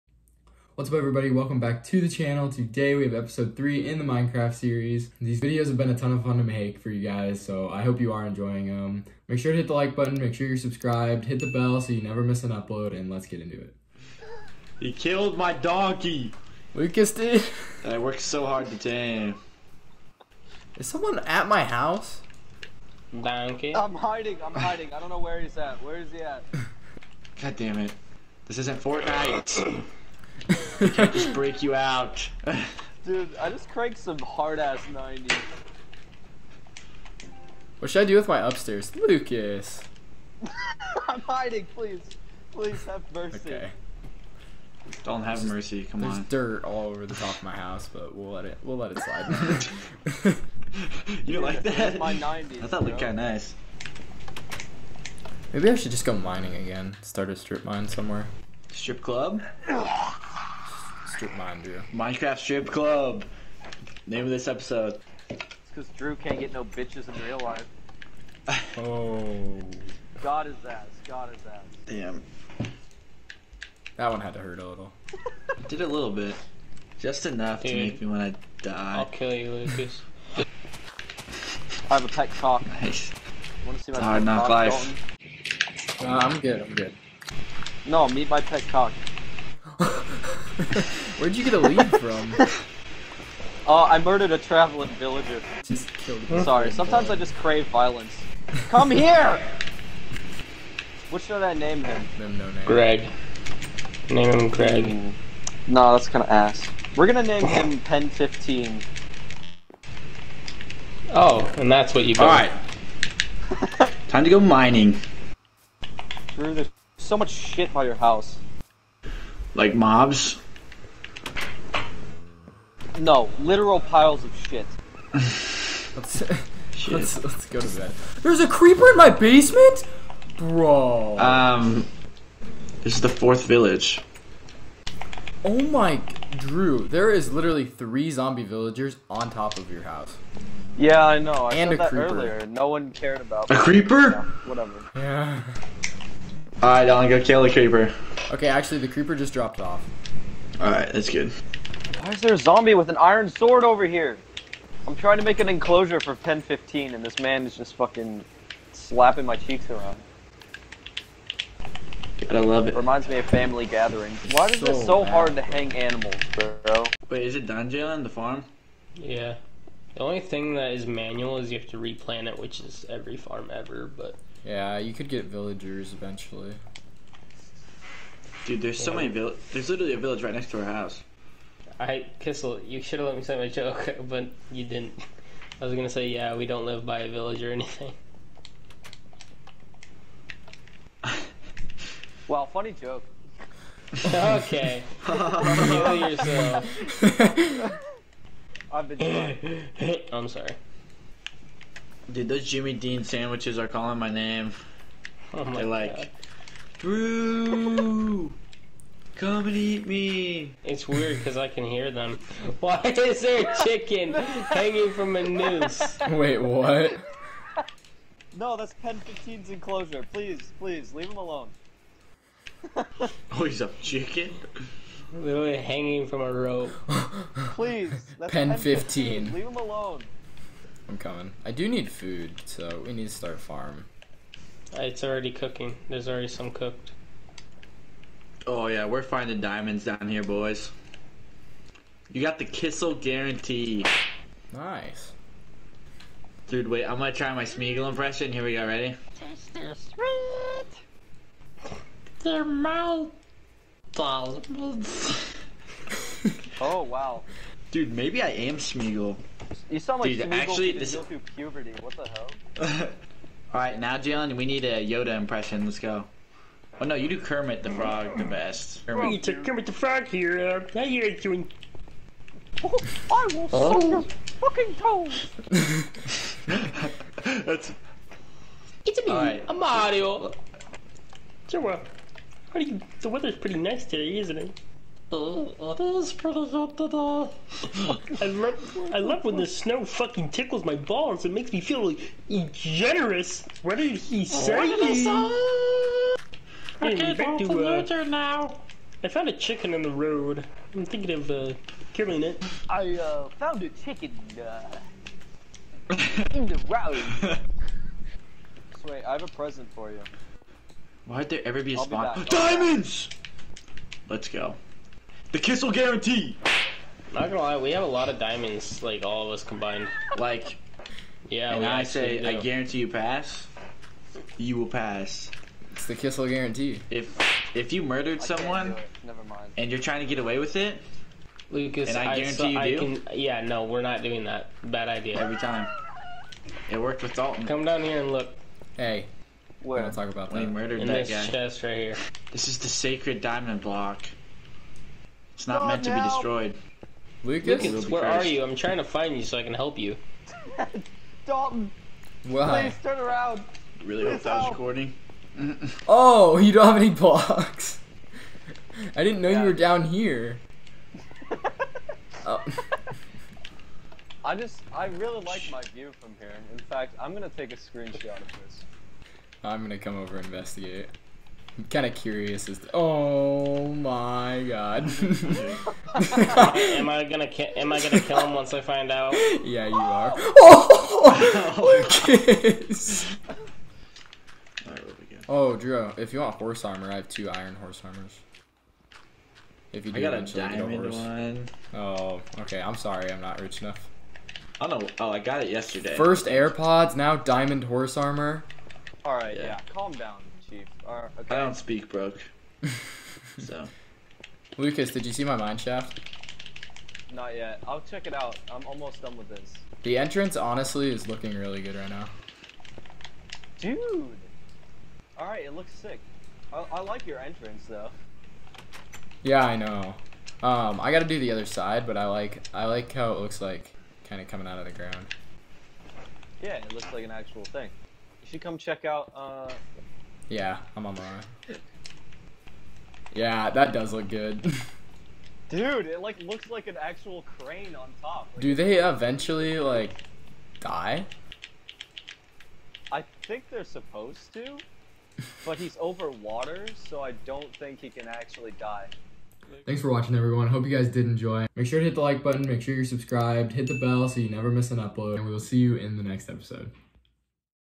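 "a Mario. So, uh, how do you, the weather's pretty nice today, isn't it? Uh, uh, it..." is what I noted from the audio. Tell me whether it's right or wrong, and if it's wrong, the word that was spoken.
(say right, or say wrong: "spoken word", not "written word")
right.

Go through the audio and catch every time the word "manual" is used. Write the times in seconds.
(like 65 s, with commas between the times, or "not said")
170 s.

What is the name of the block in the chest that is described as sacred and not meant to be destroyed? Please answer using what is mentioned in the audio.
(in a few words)
Diamond block.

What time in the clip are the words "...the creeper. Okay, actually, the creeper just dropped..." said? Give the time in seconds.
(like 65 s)
147 s.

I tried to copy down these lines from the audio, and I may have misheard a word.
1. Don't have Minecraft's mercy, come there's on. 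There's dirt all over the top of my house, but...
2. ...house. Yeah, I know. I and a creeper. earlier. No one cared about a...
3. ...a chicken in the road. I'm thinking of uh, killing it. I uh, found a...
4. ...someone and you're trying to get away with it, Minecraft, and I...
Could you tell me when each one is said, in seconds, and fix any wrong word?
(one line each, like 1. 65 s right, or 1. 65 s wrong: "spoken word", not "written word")
1. 45 s wrong: "There", not "Minecraft"
2. 139 s right
3. 299 s right
4. 328 s wrong: "Lucas", not "Minecraft".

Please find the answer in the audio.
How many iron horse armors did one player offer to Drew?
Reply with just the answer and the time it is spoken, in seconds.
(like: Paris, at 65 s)
2, at 387 s.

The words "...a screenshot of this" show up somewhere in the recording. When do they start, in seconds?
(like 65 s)
367 s.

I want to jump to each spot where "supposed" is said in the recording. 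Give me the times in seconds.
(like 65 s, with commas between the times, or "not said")
443 s.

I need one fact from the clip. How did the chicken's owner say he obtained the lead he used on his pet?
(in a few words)
Murdered a traveling villager.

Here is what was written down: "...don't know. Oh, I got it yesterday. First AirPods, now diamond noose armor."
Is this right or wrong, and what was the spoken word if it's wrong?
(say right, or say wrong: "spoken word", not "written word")
wrong: "horse", not "noose".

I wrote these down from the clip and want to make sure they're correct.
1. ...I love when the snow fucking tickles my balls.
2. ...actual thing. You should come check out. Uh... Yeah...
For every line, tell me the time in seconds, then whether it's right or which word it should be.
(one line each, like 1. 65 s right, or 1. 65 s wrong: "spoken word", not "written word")
1. 288 s right
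2. 427 s right.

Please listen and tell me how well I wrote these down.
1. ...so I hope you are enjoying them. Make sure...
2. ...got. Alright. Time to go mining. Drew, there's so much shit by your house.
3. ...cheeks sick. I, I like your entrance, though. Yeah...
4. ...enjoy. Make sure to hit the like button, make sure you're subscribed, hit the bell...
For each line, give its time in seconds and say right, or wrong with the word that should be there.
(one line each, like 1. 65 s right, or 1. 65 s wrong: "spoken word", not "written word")
1. 7 s right
2. 112 s right
3. 415 s wrong: "looks", not "cheeks"
4. 451 s right.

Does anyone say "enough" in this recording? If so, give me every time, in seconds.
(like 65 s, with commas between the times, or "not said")
77 s, 393 s.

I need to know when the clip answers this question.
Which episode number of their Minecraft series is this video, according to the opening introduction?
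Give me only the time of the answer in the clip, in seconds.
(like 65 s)
3 s.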